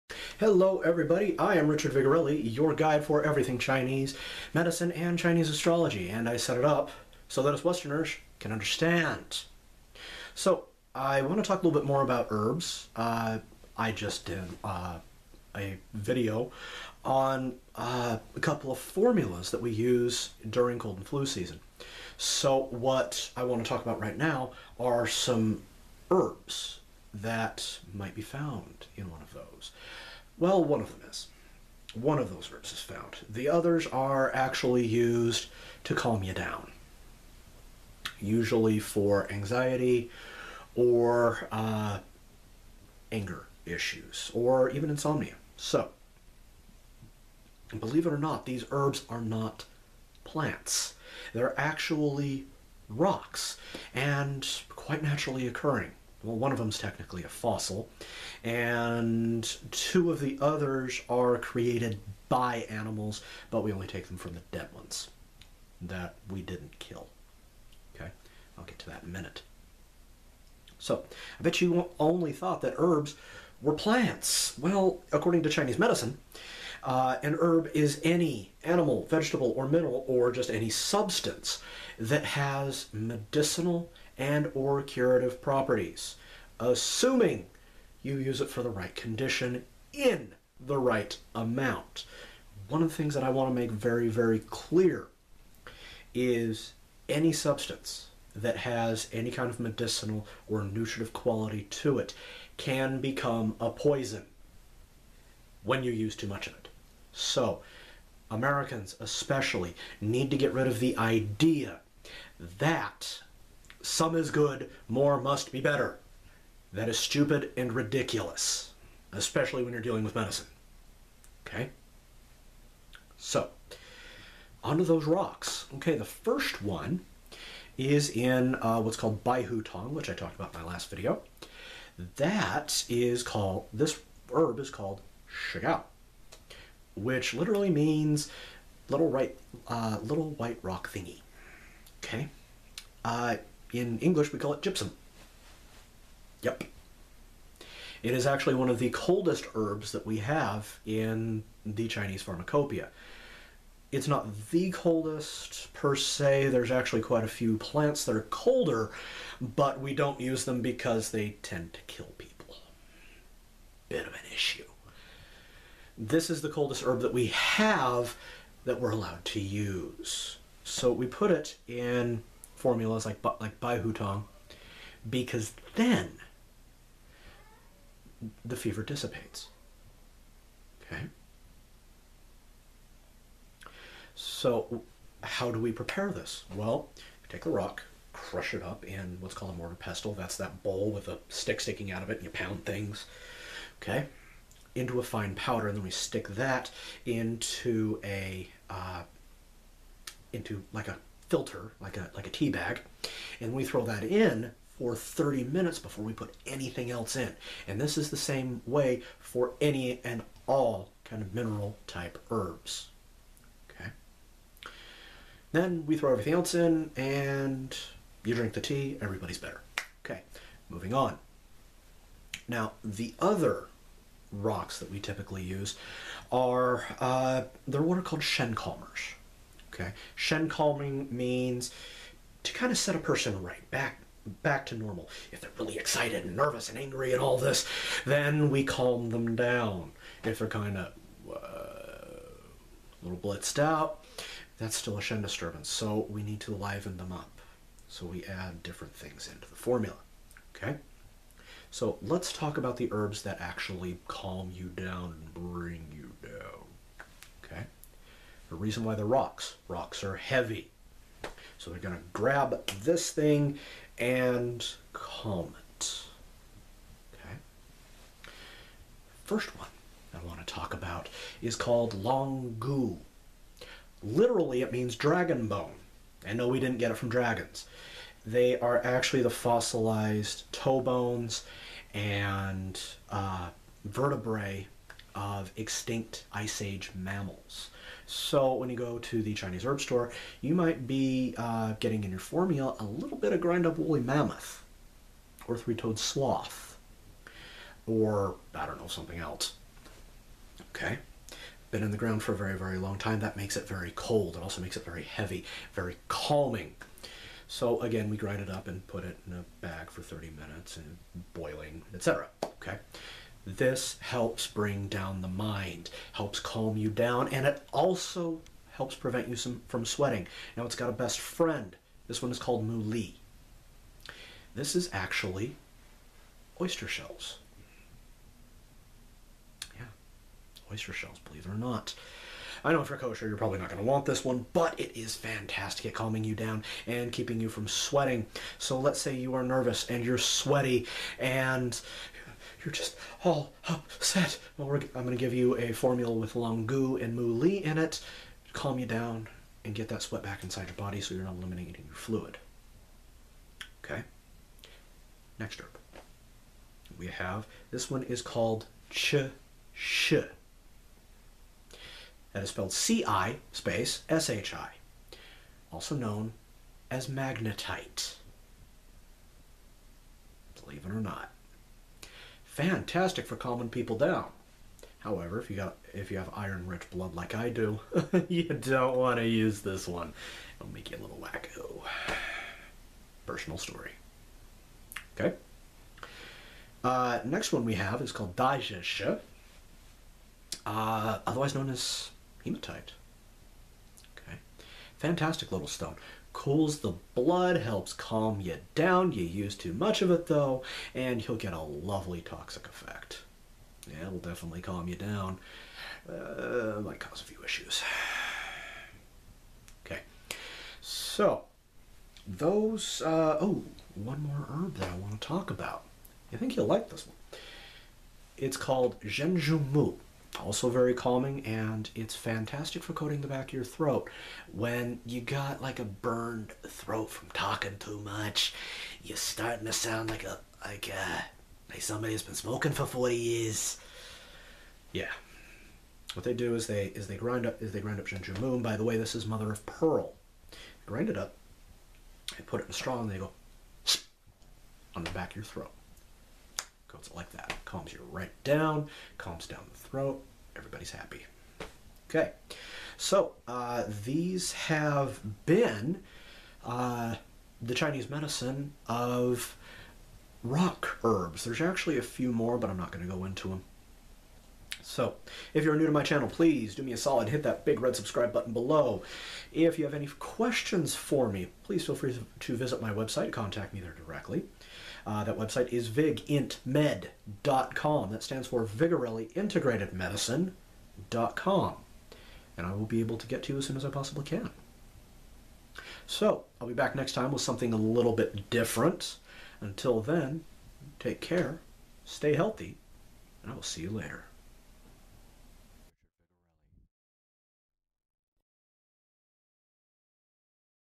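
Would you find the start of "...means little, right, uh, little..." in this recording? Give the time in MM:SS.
02:17.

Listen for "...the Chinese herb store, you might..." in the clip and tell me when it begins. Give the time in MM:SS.
04:49.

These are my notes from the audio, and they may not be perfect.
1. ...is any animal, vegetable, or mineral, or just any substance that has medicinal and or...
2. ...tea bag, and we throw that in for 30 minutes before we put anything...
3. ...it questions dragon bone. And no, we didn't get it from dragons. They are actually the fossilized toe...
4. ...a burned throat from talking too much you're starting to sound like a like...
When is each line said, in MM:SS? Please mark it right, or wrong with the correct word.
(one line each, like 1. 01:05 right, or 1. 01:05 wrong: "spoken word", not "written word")
1. 01:17 right
2. 03:22 right
3. 04:34 wrong: "means", not "questions"
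4. 07:05 right.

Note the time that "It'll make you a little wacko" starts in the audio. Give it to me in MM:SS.
06:20.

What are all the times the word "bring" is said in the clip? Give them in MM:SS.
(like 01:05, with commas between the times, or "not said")
04:15, 05:14.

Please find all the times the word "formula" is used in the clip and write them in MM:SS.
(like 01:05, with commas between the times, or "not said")
00:18, 02:52, 04:09, 04:52, 05:45.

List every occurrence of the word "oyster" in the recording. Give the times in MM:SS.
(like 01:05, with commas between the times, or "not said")
05:26, 05:30.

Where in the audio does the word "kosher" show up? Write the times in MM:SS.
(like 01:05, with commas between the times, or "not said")
05:32.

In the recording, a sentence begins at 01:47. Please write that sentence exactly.
So, Americans especially need to get rid of the idea that some is good, more must be better.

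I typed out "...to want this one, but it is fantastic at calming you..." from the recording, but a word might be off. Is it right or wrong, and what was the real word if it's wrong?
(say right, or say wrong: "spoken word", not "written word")
right.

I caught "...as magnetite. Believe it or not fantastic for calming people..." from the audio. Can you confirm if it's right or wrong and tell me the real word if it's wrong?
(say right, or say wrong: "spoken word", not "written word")
right.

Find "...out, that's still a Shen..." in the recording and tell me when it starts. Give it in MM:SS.
04:03.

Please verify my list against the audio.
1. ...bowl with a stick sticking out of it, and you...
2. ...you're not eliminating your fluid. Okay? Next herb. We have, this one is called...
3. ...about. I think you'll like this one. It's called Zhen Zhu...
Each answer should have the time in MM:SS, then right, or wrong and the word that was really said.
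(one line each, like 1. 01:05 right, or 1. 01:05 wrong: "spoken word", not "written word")
1. 03:10 right
2. 05:51 right
3. 06:55 right.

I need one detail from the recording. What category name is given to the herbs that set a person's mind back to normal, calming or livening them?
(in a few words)
Shen Calmers.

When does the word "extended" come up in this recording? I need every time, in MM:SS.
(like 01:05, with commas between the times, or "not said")
not said.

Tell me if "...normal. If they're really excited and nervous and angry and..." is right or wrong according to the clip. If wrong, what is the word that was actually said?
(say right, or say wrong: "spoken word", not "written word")
right.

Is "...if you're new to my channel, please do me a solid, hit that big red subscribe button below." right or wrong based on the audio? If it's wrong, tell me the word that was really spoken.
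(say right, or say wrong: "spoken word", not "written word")
right.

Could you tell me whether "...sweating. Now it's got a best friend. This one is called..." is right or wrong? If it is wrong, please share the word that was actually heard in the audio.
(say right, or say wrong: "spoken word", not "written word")
right.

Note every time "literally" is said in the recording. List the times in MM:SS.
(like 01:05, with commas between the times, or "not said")
02:17, 04:34.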